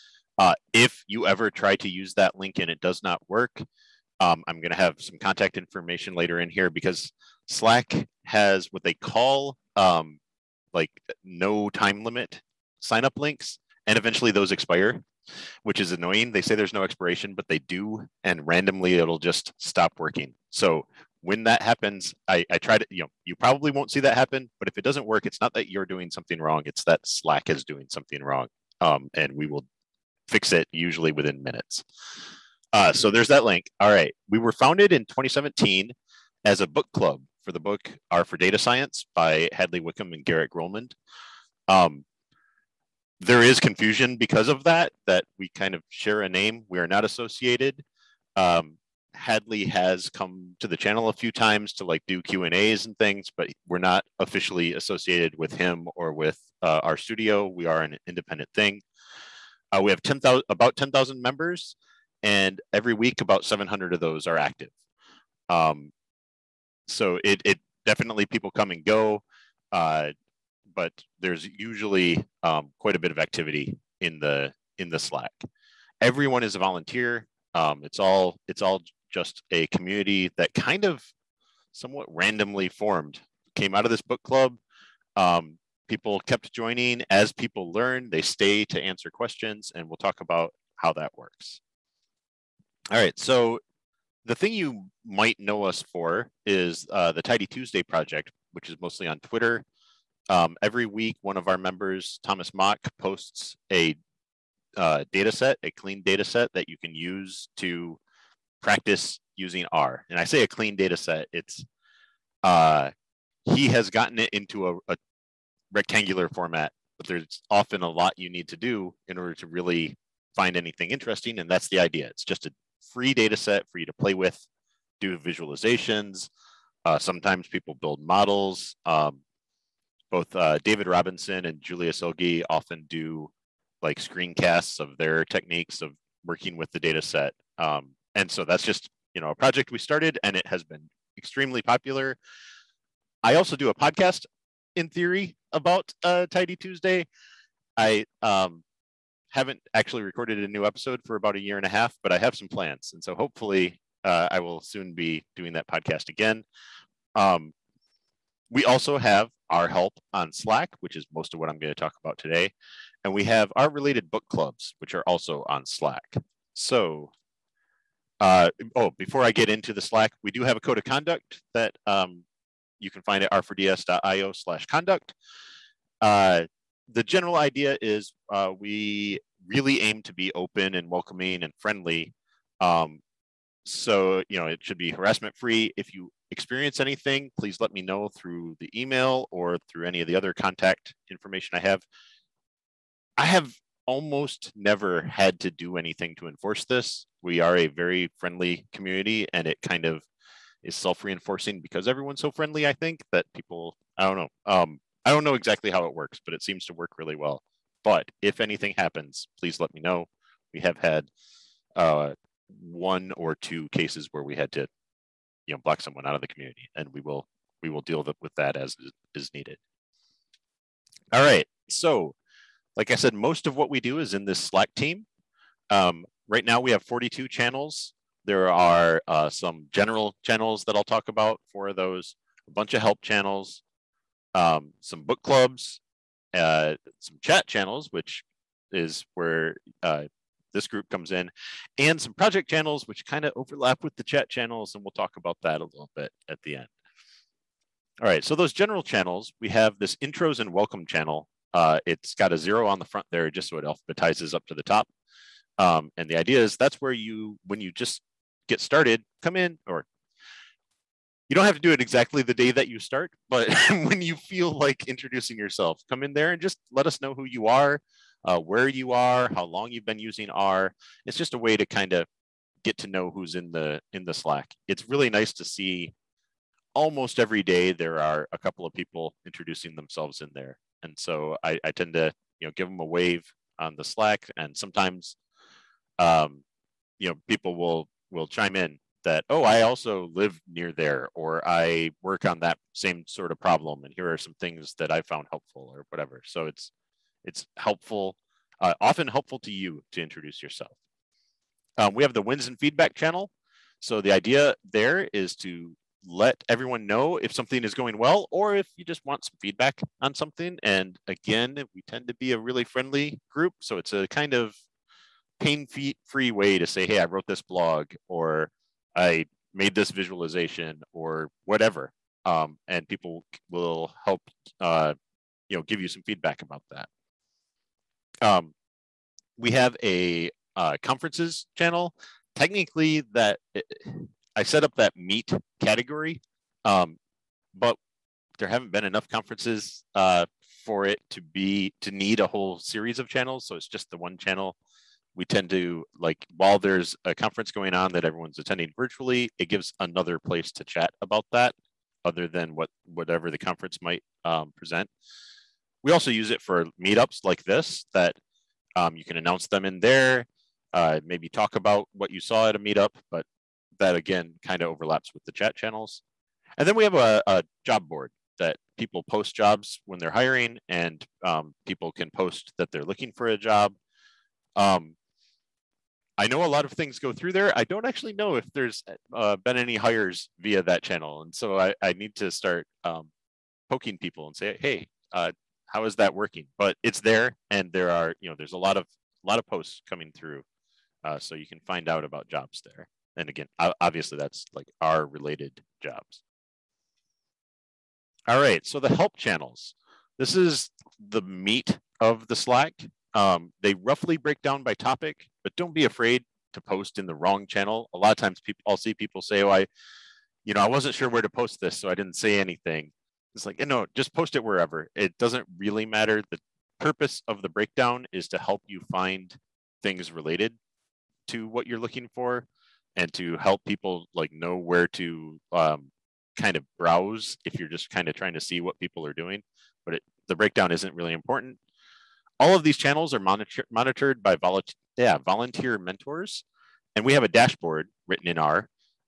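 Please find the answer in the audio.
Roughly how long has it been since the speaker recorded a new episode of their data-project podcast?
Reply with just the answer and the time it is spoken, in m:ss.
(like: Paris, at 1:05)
a year and a half, at 2:31.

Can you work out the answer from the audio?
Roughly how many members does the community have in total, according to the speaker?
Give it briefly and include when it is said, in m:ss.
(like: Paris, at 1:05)
10,000, at 1:00.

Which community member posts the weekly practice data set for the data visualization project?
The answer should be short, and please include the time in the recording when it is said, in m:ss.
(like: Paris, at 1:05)
Thomas Mock, at 1:42.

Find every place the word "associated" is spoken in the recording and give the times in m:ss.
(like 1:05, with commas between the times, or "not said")
0:47, 0:54.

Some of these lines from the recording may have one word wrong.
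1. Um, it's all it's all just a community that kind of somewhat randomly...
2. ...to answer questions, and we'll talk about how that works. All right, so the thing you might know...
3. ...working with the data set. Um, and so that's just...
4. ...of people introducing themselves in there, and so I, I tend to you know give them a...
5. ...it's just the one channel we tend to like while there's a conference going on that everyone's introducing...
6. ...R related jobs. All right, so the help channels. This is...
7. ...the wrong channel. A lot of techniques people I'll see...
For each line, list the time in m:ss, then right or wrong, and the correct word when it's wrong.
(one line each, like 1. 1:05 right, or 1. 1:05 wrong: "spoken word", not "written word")
1. 1:17 right
2. 1:28 right
3. 2:16 right
4. 4:38 right
5. 5:43 wrong: "attending", not "introducing"
6. 6:34 right
7. 6:47 wrong: "times", not "techniques".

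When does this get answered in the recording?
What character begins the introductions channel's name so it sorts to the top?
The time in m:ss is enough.
4:12.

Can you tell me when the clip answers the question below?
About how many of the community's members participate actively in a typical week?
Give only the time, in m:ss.
1:03.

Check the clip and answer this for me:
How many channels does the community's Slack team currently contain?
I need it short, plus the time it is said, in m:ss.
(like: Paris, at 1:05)
42, at 3:46.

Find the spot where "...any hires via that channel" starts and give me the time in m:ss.
6:19.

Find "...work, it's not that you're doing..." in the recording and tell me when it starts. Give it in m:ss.
0:25.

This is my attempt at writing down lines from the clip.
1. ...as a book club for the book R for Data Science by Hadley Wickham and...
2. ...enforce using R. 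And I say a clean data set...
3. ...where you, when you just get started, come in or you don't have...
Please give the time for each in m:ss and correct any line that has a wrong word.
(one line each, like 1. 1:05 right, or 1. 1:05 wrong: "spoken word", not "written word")
1. 0:36 right
2. 1:48 wrong: "practice", not "enforce"
3. 4:16 right.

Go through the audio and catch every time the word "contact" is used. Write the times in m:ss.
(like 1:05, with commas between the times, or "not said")
0:05, 3:10.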